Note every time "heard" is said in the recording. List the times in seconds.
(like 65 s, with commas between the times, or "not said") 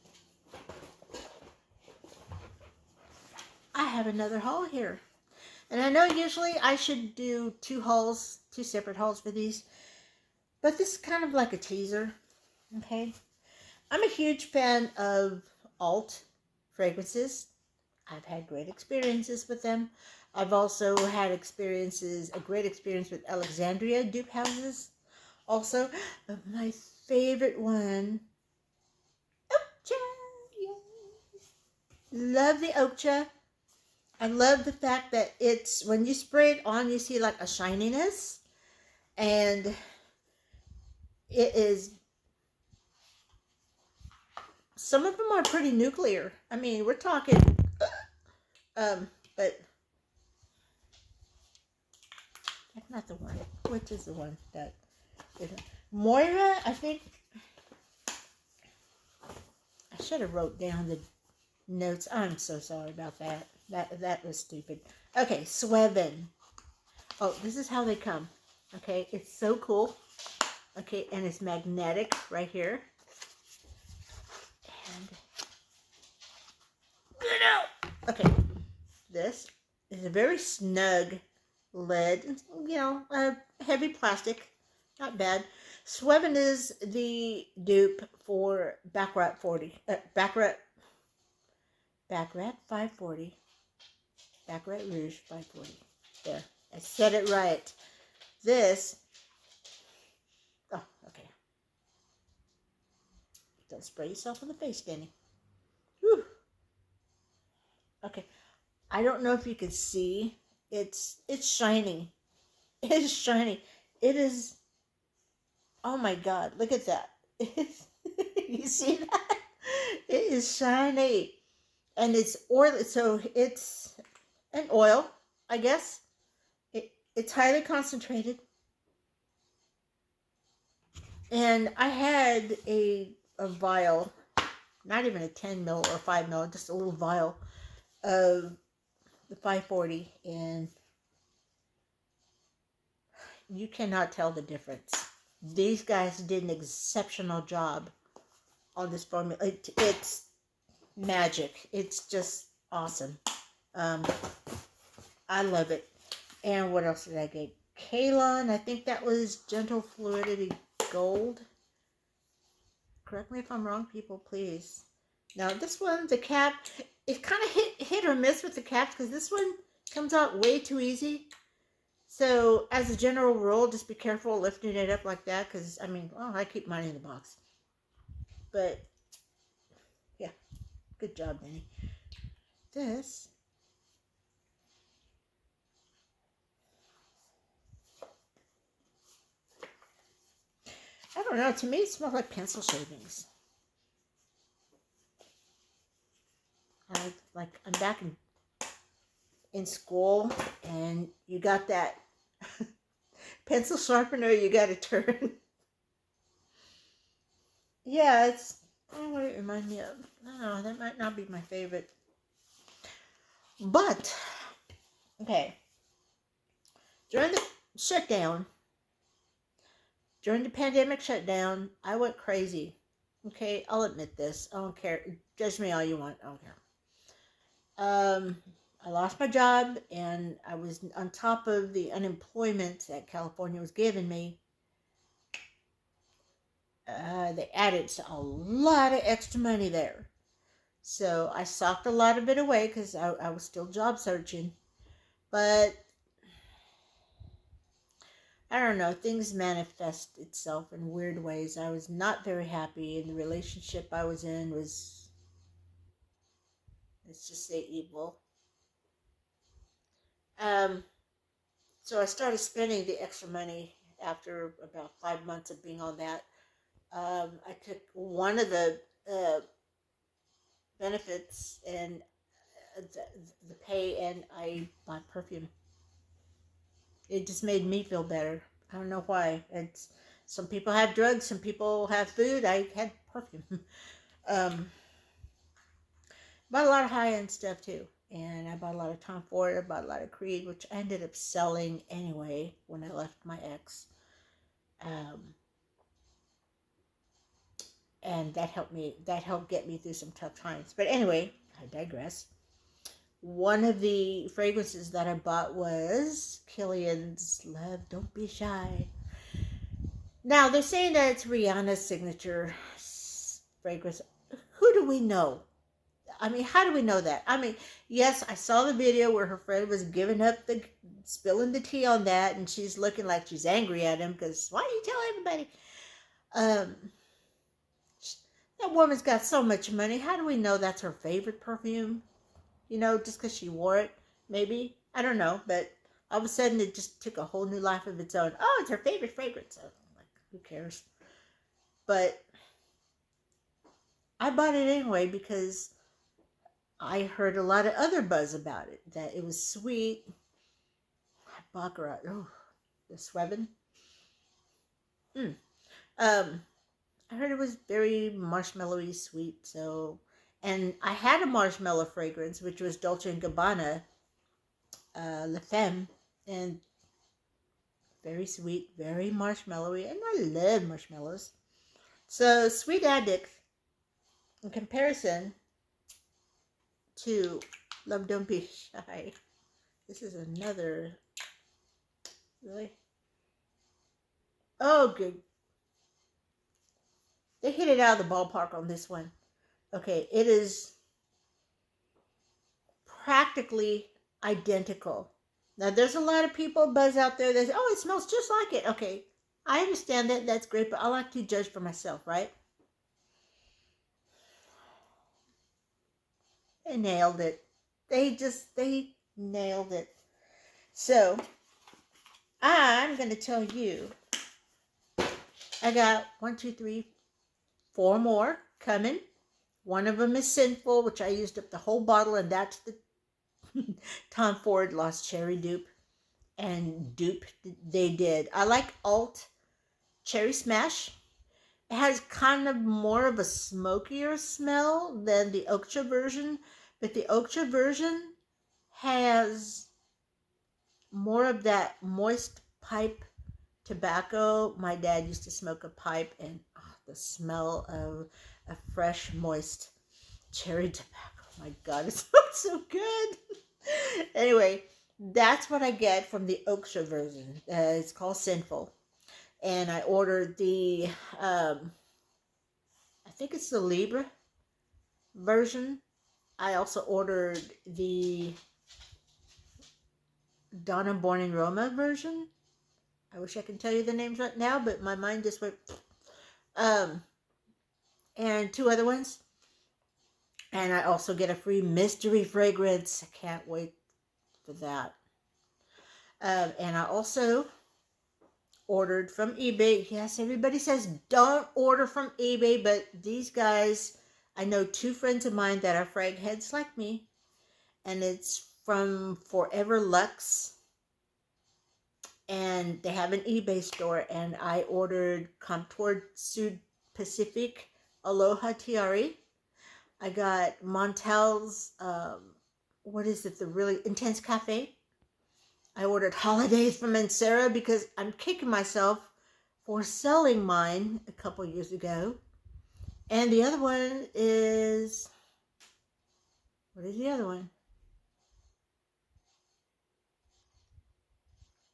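347 s, 357 s.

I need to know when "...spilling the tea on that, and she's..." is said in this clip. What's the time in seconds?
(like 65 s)
321 s.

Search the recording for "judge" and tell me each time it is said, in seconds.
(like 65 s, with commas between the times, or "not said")
225 s, 401 s.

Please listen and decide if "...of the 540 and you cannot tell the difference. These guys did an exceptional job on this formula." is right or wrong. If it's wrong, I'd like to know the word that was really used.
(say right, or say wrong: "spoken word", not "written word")
right.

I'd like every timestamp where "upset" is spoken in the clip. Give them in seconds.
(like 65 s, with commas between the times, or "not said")
not said.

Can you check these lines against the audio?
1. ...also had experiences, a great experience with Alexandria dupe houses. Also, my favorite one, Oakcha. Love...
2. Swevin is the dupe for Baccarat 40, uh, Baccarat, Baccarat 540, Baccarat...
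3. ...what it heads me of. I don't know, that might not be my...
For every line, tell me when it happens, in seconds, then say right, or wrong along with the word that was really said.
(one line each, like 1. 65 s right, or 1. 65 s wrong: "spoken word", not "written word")
1. 20 s right
2. 85 s right
3. 208 s wrong: "reminds", not "heads".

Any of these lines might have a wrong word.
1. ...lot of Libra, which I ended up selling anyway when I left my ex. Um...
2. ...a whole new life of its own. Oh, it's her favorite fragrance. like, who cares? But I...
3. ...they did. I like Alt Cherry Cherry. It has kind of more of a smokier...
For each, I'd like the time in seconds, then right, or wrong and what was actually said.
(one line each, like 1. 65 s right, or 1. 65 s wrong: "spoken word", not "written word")
1. 289 s wrong: "Creed", not "Libra"
2. 337 s right
3. 427 s wrong: "Smash", not "Cherry".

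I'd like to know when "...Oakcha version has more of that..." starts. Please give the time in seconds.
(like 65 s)
437 s.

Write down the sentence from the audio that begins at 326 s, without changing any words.
Um, that woman's got so much money.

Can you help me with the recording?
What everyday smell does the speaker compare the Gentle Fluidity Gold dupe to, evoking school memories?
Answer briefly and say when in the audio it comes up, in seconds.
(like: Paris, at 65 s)
Pencil shavings, at 192 s.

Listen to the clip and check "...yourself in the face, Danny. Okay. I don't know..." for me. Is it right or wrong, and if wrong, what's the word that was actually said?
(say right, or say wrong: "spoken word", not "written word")
right.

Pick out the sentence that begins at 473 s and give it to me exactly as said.
I wish I can tell you the names right now, but my mind just went.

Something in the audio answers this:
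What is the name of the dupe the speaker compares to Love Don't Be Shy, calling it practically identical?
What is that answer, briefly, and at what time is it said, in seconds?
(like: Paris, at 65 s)
Sweet Addict, at 372 s.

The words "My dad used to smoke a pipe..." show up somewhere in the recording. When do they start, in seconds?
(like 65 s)
444 s.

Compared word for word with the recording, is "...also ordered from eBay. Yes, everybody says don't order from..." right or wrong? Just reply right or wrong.
right.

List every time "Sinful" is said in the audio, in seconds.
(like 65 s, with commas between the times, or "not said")
420 s, 458 s.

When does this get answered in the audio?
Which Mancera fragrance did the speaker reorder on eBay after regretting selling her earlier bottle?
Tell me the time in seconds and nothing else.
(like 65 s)
516 s.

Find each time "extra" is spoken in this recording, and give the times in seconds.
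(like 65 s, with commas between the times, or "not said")
239 s, 263 s.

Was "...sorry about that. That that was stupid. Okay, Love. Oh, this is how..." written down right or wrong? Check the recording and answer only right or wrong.
wrong.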